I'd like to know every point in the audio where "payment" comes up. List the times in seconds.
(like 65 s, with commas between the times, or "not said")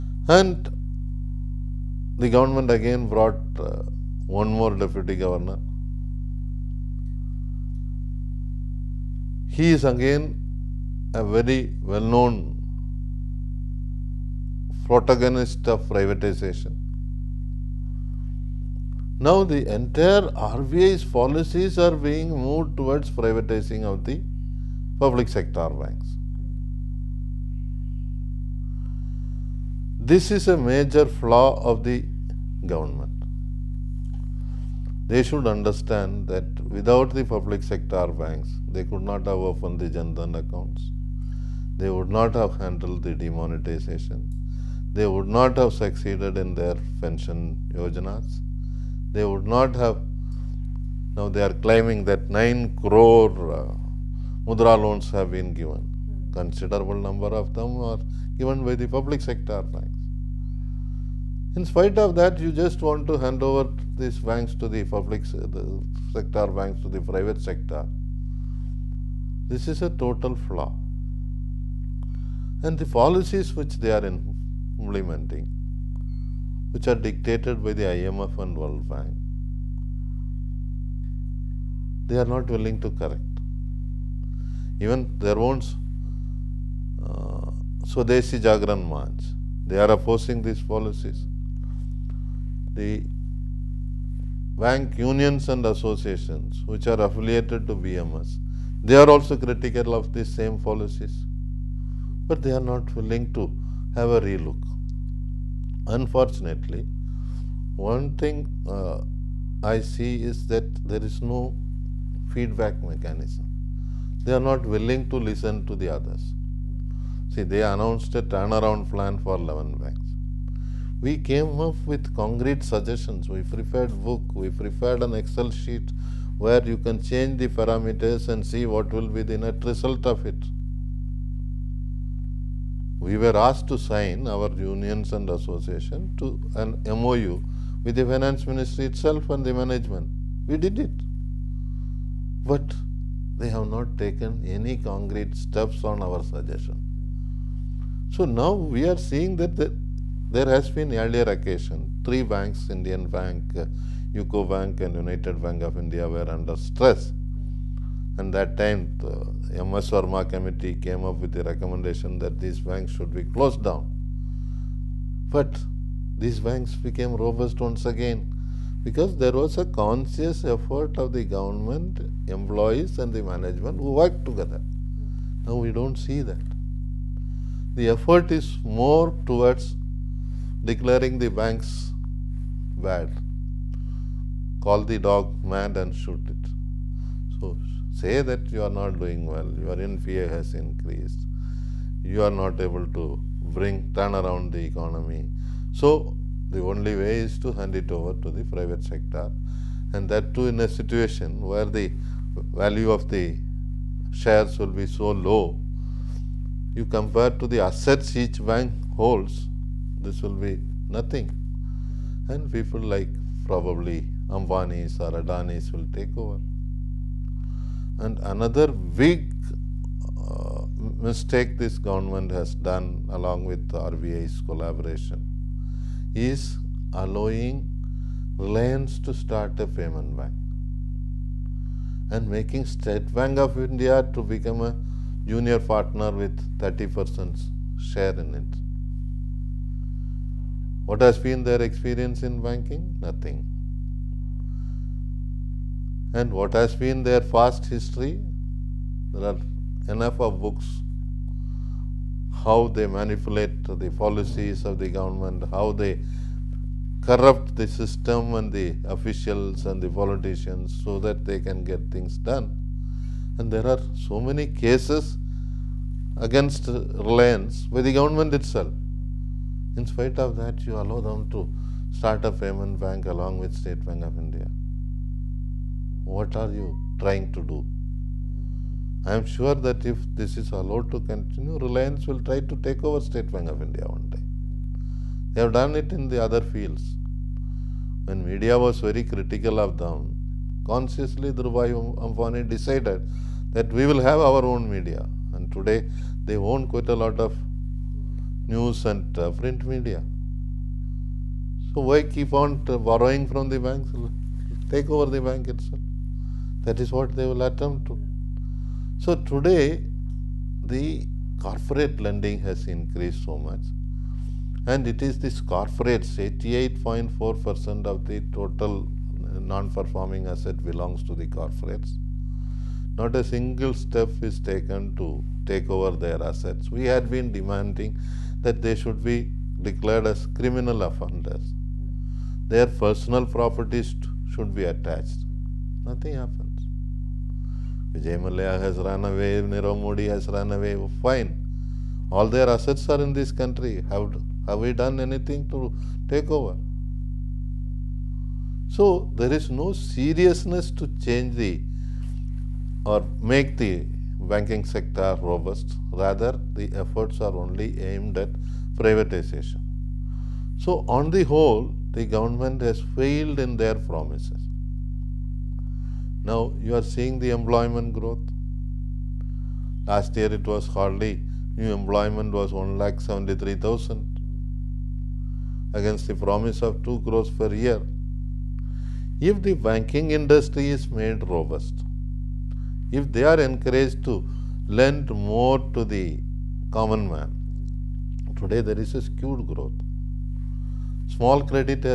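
229 s, 272 s.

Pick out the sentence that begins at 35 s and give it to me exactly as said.
They should understand that without the public sector banks, they could not have opened the Jandhan accounts.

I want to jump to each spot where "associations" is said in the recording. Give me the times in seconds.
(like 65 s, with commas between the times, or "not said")
95 s, 135 s.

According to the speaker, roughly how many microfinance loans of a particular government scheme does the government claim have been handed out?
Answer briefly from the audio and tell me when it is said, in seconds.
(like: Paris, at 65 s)
9 crore, at 52 s.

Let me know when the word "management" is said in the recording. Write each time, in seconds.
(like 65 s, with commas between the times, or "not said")
139 s, 173 s.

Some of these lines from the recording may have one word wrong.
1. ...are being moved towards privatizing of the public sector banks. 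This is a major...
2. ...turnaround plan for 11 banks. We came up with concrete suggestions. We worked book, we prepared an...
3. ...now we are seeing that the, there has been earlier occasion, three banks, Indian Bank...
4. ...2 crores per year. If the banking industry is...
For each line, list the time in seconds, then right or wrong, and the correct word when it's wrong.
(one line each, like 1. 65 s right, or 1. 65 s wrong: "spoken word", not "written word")
1. 21 s right
2. 118 s wrong: "prepared", not "worked"
3. 148 s right
4. 376 s right.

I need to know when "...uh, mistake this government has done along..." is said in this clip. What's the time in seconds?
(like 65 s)
220 s.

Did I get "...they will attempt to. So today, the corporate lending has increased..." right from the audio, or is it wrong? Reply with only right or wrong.
right.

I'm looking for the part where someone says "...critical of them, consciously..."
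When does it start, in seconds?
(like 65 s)
289 s.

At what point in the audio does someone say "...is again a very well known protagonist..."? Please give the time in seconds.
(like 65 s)
9 s.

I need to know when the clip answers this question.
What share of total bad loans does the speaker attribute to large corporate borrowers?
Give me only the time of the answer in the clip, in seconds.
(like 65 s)
316 s.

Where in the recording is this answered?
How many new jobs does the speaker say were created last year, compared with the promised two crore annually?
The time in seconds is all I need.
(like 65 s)
372 s.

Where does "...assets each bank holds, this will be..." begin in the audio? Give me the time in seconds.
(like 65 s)
207 s.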